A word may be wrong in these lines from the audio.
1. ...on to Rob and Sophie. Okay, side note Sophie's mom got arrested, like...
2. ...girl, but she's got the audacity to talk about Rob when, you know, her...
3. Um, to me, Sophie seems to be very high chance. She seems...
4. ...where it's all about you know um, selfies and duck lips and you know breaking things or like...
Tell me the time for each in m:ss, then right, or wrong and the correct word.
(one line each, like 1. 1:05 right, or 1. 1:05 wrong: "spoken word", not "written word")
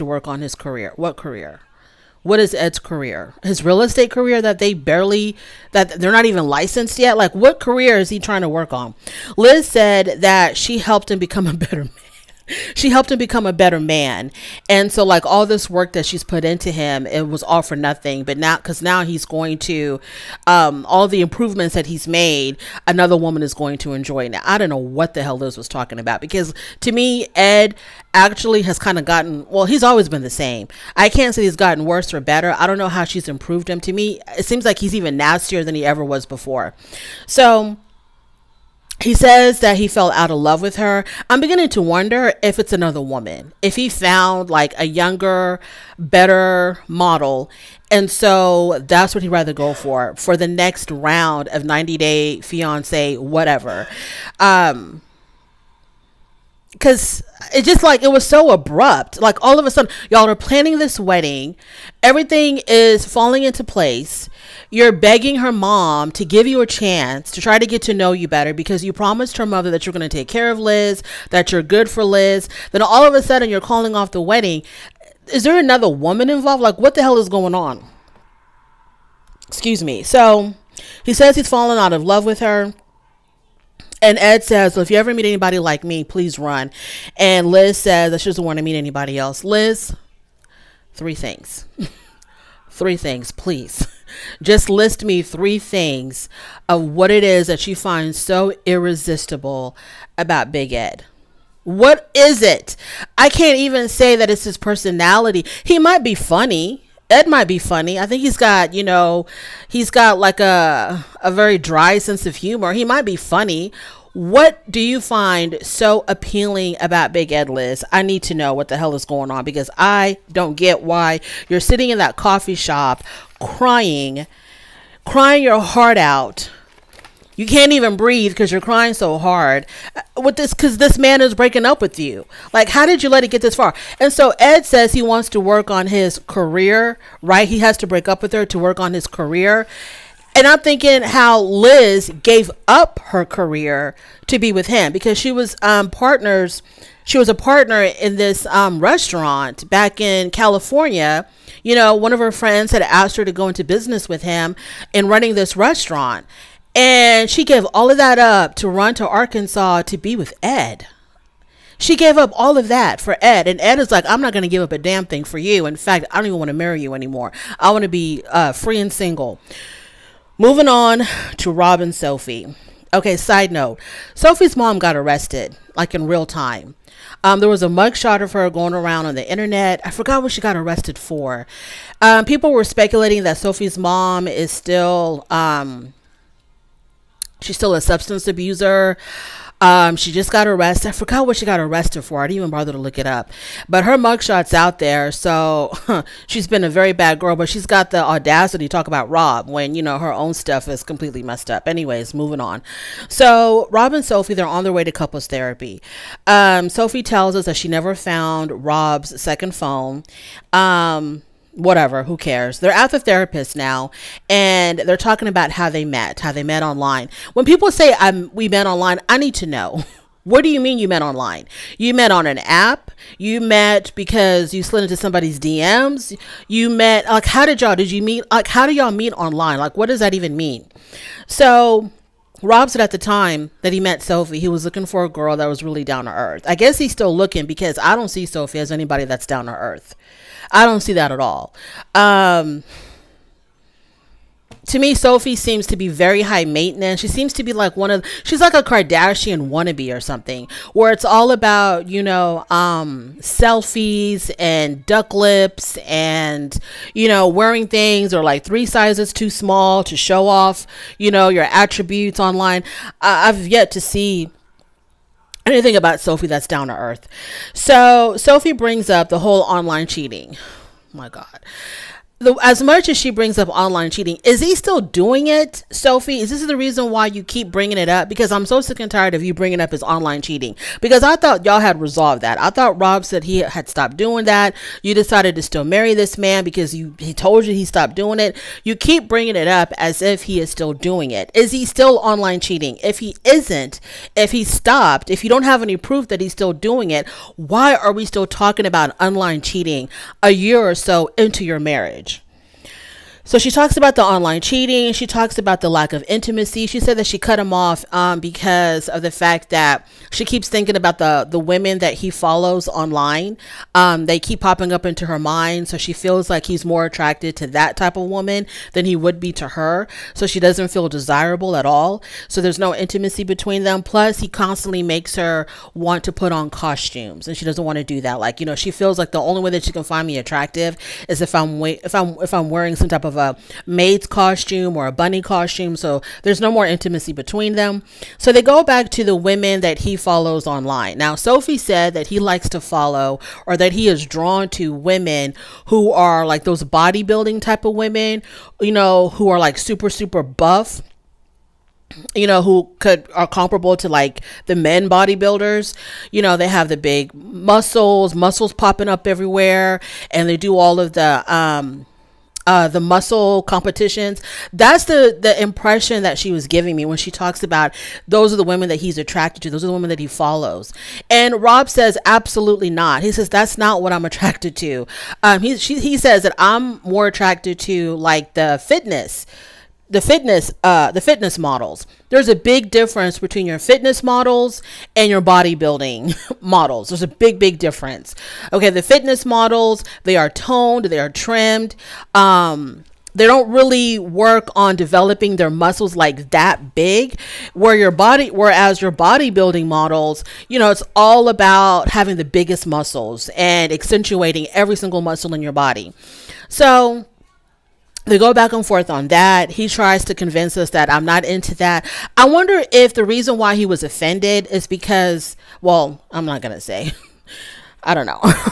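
1. 2:50 right
2. 3:17 right
3. 4:01 wrong: "maintenance", not "chance"
4. 4:10 wrong: "wearing", not "breaking".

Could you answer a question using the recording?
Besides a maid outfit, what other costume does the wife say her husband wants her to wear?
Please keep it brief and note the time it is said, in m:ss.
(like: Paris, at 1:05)
Bunny costume, at 5:34.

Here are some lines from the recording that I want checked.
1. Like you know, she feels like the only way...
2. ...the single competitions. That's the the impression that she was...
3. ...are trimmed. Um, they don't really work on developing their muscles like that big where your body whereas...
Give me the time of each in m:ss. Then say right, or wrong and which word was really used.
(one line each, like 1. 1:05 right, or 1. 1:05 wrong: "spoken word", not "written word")
1. 5:28 right
2. 6:02 wrong: "muscle", not "single"
3. 6:30 right.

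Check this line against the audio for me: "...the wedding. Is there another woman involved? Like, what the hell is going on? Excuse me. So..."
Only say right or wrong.
right.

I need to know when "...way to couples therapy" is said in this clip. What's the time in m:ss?
3:24.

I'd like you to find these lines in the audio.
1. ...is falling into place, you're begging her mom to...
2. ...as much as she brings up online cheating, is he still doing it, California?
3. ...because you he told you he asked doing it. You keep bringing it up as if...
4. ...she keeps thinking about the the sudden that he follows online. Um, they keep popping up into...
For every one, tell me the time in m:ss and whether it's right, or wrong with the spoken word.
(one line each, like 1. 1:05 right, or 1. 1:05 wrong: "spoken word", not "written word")
1. 1:02 right
2. 4:32 wrong: "Sophie", not "California"
3. 4:46 wrong: "stopped", not "asked"
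4. 5:10 wrong: "women", not "sudden".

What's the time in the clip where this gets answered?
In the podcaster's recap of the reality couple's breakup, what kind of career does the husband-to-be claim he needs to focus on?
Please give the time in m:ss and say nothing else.
0:03.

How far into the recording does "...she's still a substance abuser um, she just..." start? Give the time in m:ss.
3:07.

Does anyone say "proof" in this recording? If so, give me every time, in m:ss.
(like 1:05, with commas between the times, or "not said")
4:55.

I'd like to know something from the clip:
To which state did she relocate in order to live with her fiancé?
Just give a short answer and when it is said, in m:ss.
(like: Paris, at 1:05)
Arkansas, at 2:39.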